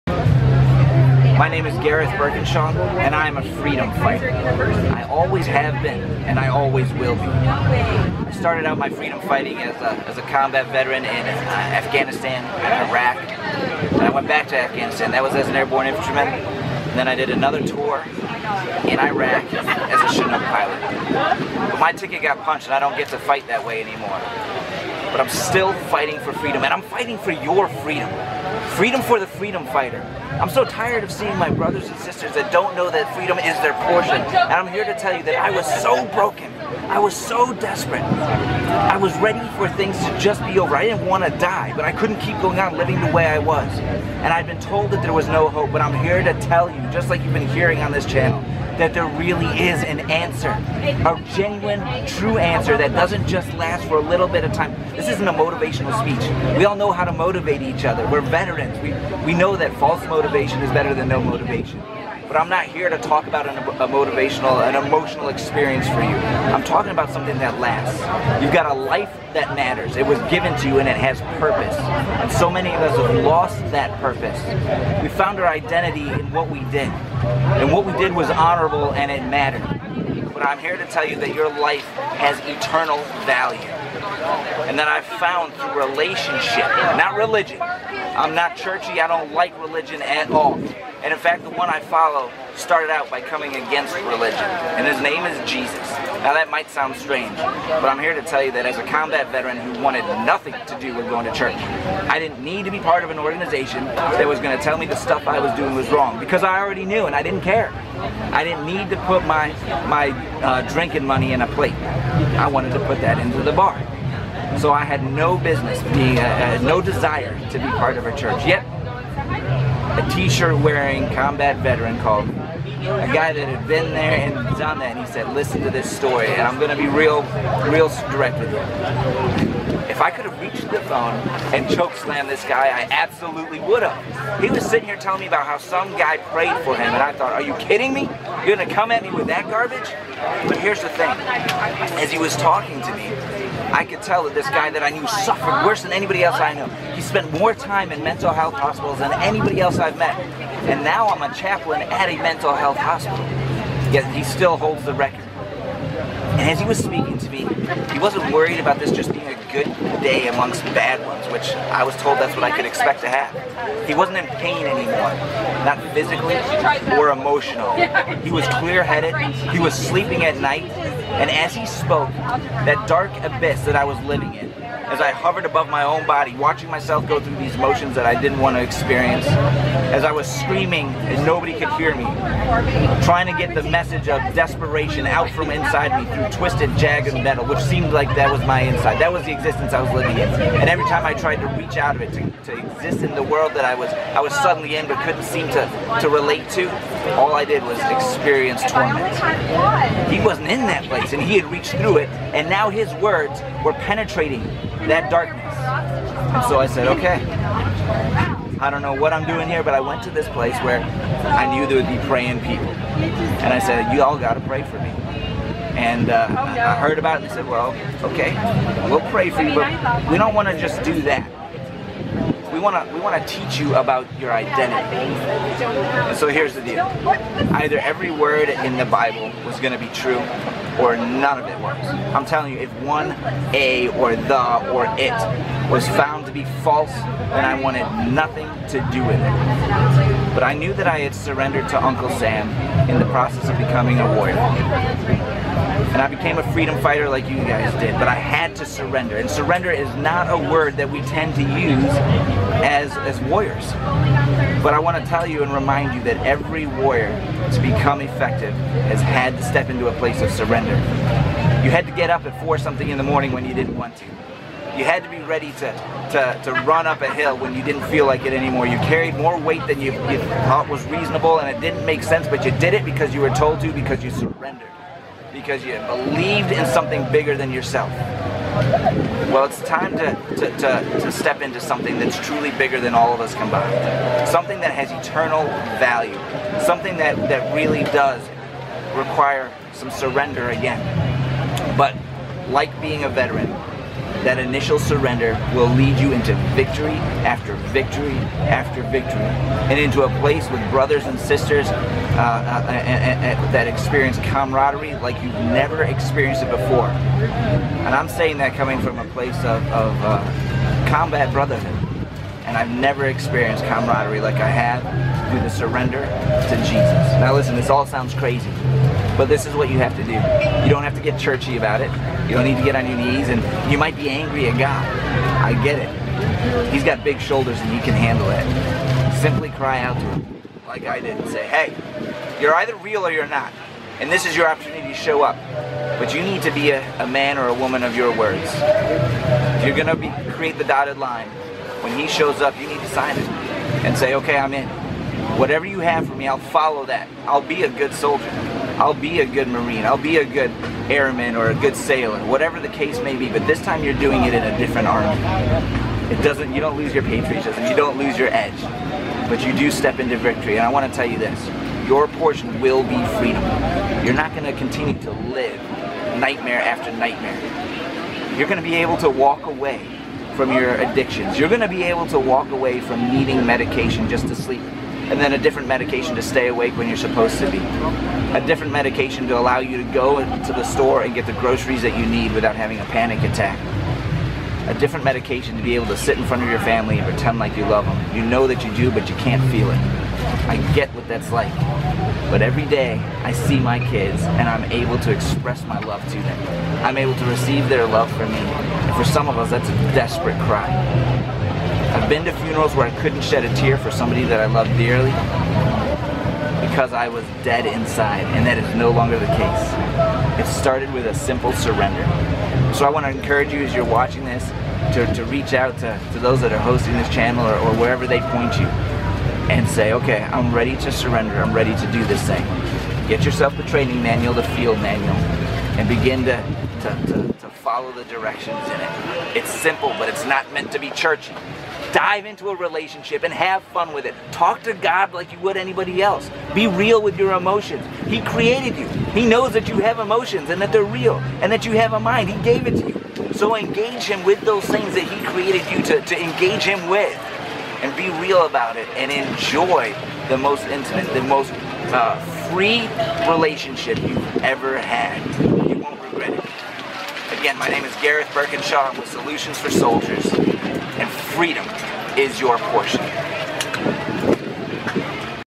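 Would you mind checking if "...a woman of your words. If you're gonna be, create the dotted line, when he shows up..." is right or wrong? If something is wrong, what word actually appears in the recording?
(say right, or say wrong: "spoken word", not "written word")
right.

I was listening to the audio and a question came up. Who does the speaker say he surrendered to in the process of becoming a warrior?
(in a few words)
Uncle Sam.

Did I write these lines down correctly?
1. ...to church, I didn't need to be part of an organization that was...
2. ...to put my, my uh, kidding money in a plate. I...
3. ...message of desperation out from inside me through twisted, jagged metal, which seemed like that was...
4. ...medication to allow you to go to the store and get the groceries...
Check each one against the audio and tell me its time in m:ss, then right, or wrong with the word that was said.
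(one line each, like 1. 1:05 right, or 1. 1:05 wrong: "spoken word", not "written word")
1. 1:41 right
2. 1:48 wrong: "drinking", not "kidding"
3. 3:03 right
4. 6:18 right.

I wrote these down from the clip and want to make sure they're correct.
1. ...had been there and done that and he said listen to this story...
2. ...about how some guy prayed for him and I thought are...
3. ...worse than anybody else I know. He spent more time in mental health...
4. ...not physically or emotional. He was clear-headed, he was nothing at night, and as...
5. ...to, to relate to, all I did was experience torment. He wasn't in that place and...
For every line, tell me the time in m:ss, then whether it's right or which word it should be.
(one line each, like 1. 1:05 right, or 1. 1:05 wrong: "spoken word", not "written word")
1. 2:03 right
2. 2:15 right
3. 2:25 right
4. 2:45 wrong: "sleeping", not "nothing"
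5. 3:15 right.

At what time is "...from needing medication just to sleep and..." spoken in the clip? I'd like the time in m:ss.
6:12.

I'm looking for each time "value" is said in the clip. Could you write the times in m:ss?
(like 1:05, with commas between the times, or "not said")
1:23, 4:45.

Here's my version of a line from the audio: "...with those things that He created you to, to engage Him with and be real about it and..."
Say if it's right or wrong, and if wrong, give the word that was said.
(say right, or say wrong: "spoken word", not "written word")
right.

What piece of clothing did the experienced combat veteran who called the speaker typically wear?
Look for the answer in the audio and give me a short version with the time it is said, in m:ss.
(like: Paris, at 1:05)
T-shirt, at 2:00.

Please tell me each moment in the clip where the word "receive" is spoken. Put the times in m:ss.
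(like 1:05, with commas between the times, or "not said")
6:37.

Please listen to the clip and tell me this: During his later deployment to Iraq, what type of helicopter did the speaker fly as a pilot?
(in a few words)
Chinook.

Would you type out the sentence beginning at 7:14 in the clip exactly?
Talk to God like you would anybody else.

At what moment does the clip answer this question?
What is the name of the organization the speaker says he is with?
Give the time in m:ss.
7:39.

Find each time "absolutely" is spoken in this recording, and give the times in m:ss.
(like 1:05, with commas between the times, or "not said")
2:12.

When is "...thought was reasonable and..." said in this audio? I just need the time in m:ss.
4:30.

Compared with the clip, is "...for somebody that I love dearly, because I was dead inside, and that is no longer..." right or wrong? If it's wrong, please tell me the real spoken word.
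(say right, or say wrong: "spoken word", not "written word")
right.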